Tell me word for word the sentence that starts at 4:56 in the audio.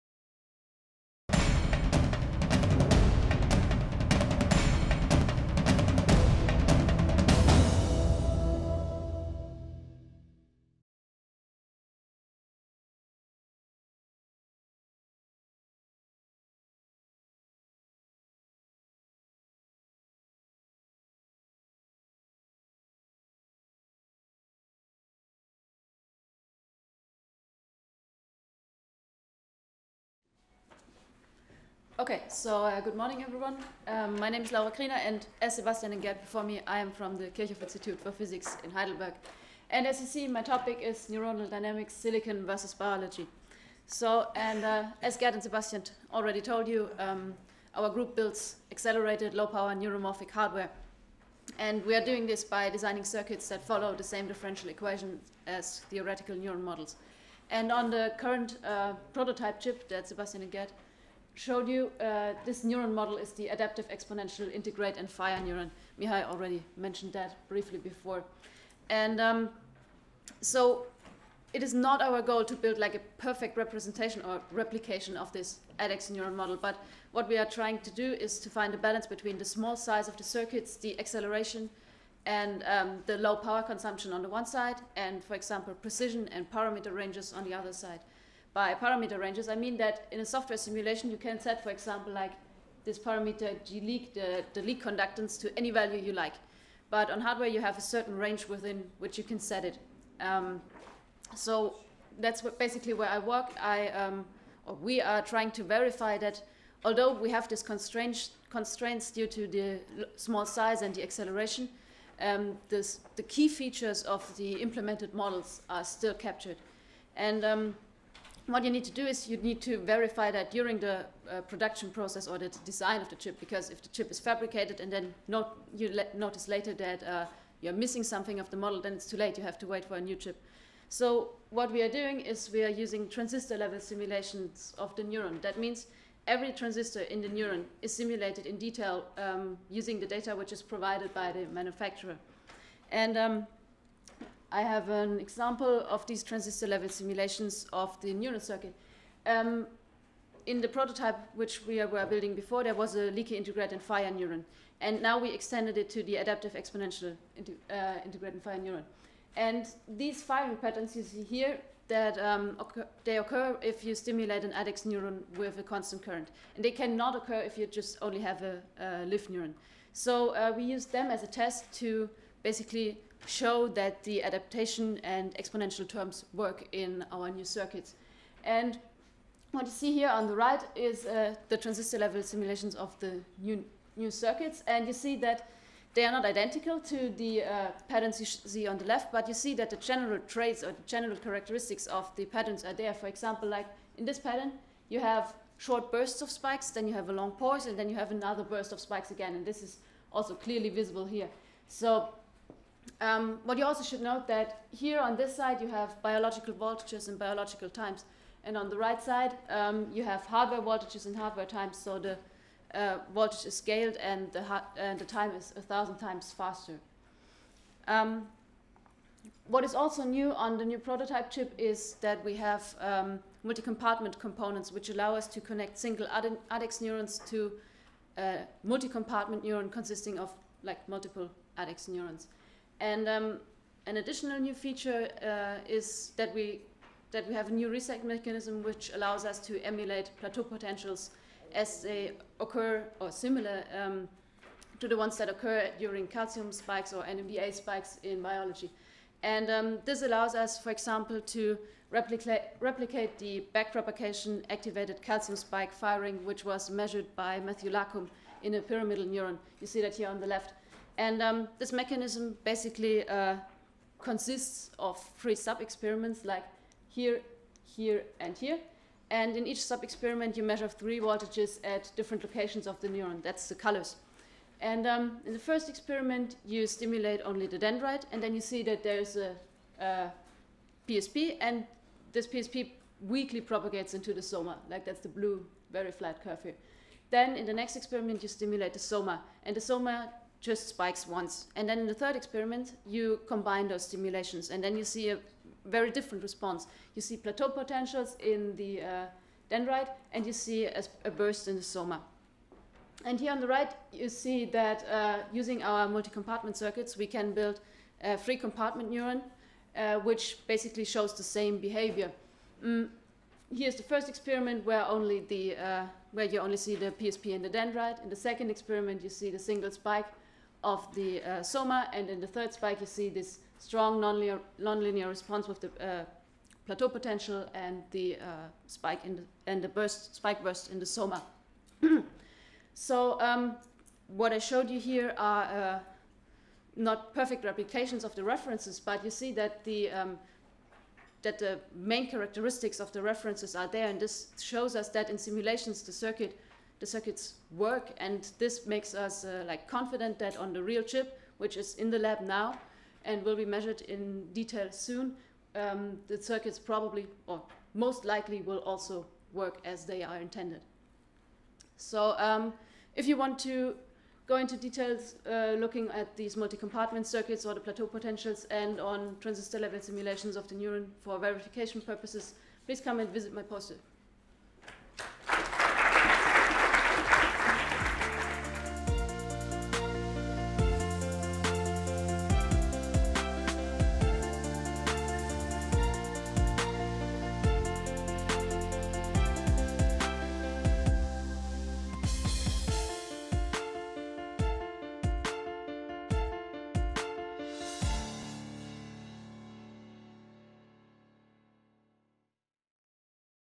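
You see plateau potentials in the uh, dendrite, and you see a, a, burst in the soma.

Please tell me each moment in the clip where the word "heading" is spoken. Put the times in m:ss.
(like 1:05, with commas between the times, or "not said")
not said.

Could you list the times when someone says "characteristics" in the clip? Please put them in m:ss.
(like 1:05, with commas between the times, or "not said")
3:11, 5:42.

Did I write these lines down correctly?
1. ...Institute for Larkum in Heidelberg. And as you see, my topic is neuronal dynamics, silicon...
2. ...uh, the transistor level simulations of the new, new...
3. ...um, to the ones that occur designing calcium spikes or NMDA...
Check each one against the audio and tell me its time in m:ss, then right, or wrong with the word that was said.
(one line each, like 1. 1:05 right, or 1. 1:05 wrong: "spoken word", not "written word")
1. 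0:37 wrong: "Physics", not "Larkum"
2. 3:01 right
3. 4:03 wrong: "during", not "designing".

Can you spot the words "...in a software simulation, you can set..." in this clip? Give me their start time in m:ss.
1:30.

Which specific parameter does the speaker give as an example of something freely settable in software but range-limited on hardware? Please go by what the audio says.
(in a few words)
Leak conductance.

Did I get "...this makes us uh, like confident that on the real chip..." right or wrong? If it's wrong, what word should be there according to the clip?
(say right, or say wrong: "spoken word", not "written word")
right.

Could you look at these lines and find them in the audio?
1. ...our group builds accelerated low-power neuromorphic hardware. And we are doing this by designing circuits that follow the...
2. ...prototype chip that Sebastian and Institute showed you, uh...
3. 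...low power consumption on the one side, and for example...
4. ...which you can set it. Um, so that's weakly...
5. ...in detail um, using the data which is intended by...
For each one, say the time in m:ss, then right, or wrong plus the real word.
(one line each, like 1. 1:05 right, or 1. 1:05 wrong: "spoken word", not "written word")
1. 0:47 right
2. 0:59 wrong: "Gerd", not "Institute"
3. 1:23 right
4. 1:38 wrong: "basically", not "weakly"
5. 2:18 wrong: "provided", not "intended".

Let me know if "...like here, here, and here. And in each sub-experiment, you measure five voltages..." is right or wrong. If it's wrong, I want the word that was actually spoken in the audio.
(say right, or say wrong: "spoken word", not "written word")
wrong: "three", not "five".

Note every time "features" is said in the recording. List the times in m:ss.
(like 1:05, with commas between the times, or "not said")
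1:53, 3:54.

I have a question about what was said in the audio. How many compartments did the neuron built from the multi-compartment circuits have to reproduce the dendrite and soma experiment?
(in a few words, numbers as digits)
3.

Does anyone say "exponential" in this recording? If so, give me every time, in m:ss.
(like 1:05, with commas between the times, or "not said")
1:03, 2:36, 2:55.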